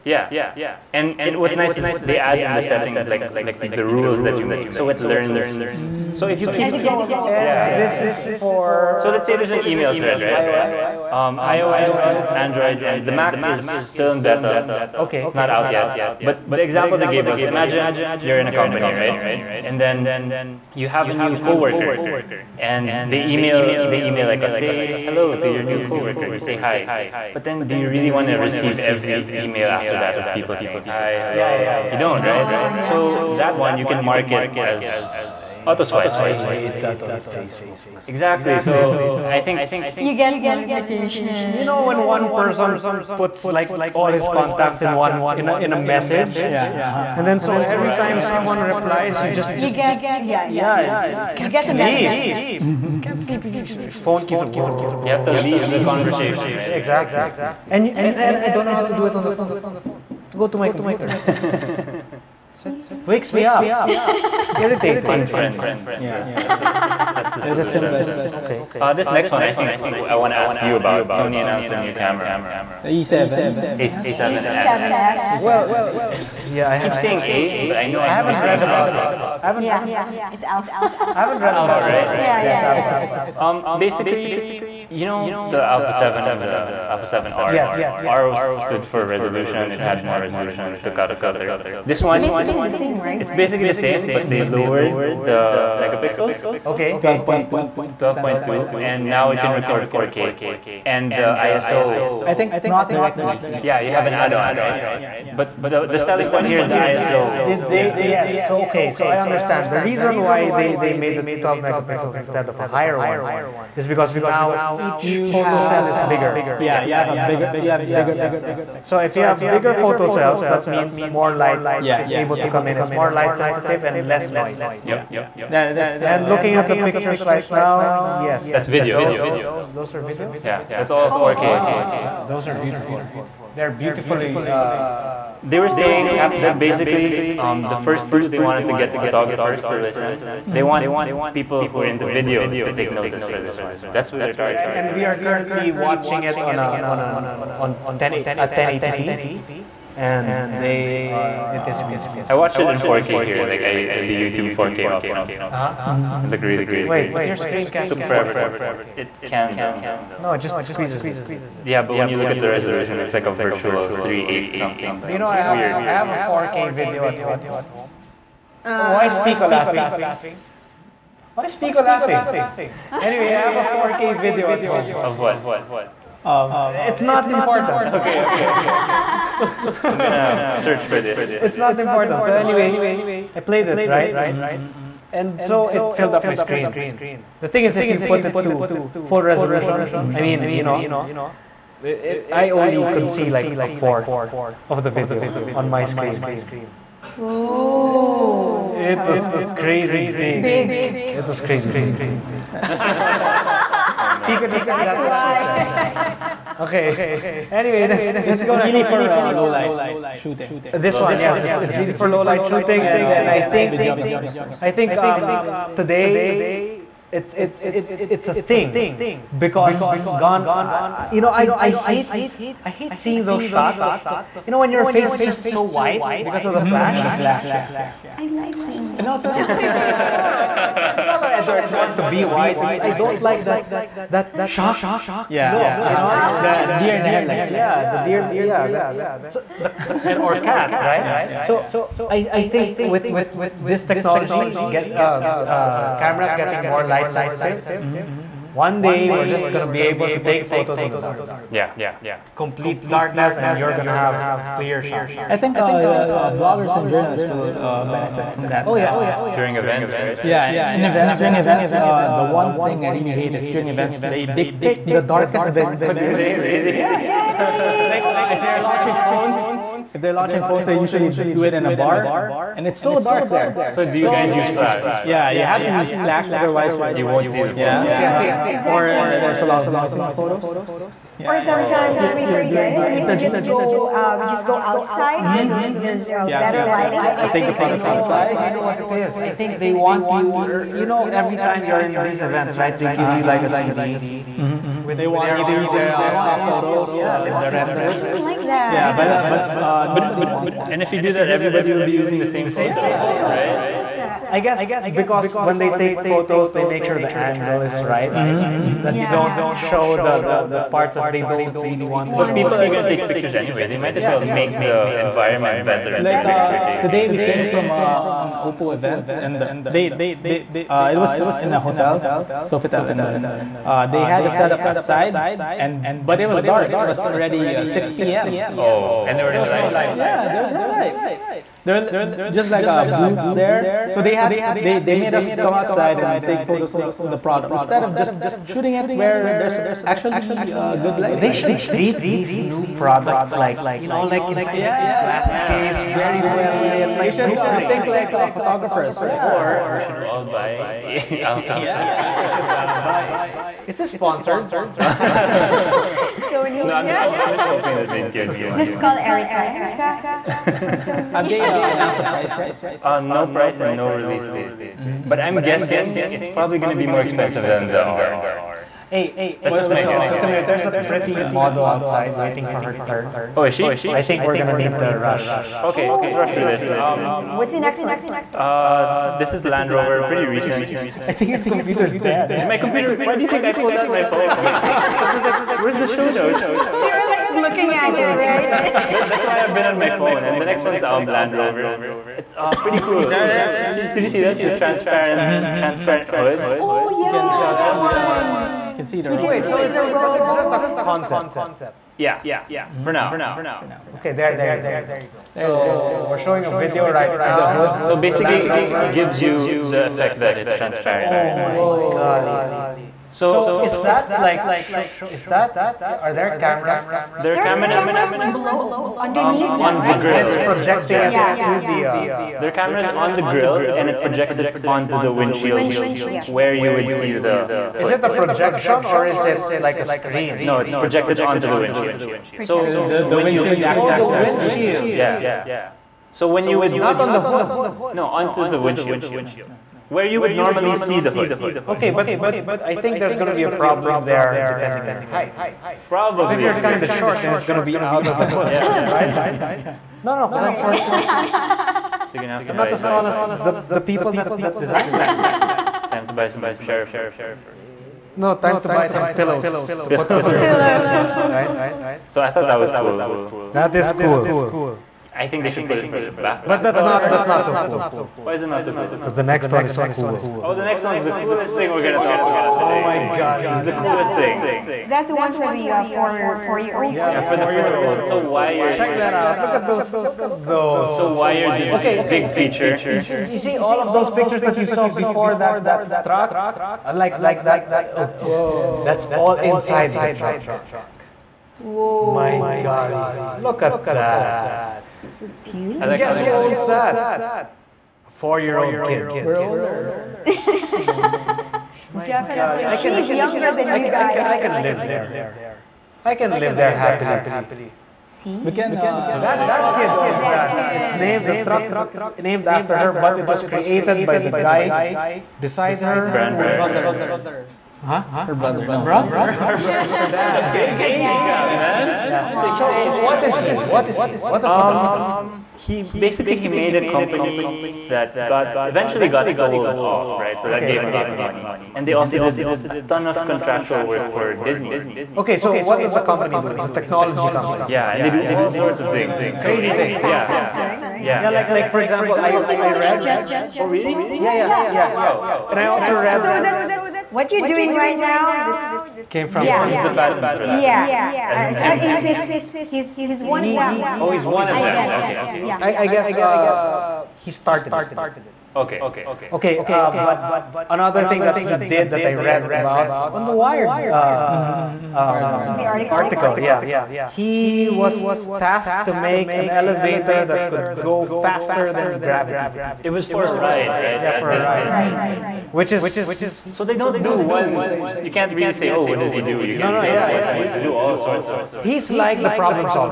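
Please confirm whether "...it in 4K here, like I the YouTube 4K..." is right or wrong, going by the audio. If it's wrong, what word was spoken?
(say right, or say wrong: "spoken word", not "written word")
right.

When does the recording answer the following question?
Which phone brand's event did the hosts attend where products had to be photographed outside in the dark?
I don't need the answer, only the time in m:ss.
5:18.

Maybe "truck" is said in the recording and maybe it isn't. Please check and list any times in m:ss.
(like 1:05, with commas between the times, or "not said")
8:06, 8:10, 8:31.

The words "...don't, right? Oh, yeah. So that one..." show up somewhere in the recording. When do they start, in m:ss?
0:31.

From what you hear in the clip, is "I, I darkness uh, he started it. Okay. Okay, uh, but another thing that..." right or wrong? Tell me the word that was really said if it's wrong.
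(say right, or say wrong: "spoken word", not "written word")
wrong: "guess", not "darkness".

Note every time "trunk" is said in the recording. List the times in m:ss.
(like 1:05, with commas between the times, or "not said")
not said.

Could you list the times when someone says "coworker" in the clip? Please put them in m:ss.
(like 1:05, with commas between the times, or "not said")
0:21, 0:25.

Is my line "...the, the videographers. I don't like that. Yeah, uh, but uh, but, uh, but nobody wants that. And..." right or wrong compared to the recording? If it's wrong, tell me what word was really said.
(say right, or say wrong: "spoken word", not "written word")
wrong: "renders", not "videographers".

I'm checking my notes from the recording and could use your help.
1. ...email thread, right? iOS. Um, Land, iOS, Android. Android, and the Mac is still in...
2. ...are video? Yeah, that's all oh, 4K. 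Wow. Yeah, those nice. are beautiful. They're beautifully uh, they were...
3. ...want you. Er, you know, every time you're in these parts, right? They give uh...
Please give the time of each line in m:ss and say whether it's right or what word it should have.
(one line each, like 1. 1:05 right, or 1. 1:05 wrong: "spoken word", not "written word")
1. 0:09 wrong: "Android", not "Land"
2. 2:09 right
3. 4:49 wrong: "events", not "parts".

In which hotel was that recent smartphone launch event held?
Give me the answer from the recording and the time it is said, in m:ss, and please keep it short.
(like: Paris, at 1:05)
Sofitel, at 5:22.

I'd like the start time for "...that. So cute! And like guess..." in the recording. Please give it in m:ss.
8:13.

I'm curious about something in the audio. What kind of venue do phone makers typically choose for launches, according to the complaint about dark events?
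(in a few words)
A bar.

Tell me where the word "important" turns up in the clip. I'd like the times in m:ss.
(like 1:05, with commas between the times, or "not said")
2:57, 3:01.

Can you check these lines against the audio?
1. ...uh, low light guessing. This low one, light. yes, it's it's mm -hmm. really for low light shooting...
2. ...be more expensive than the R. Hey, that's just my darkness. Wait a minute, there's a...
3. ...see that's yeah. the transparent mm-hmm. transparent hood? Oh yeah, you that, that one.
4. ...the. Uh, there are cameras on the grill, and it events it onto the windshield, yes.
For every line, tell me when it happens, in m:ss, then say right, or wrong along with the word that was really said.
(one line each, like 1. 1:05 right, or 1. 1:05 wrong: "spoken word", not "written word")
1. 3:29 wrong: "shooting", not "guessing"
2. 6:06 wrong: "guess", not "darkness"
3. 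6:34 right
4. 7:01 wrong: "projects", not "events".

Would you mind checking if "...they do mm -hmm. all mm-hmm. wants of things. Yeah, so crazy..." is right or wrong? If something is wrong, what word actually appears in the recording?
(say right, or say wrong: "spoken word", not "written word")
wrong: "sorts", not "wants".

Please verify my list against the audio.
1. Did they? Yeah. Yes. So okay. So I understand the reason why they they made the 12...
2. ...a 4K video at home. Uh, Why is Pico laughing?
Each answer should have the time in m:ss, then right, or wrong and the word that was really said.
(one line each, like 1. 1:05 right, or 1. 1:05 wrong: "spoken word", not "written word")
1. 1:47 right
2. 2:46 right.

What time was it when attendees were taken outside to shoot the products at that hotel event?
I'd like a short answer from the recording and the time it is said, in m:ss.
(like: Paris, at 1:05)
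6 p.m., at 5:27.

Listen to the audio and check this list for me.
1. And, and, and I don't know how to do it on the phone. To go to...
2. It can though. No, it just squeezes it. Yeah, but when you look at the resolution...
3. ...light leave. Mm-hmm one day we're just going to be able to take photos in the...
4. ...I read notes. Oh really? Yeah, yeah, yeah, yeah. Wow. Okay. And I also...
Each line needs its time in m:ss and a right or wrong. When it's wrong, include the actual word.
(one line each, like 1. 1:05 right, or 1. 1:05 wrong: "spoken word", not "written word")
1. 0:57 right
2. 2:38 right
3. 4:06 wrong: "sensitive", not "leave"
4. 9:02 wrong: "gestures", not "notes".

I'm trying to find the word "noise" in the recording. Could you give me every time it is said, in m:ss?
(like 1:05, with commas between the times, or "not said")
2:04, 4:39.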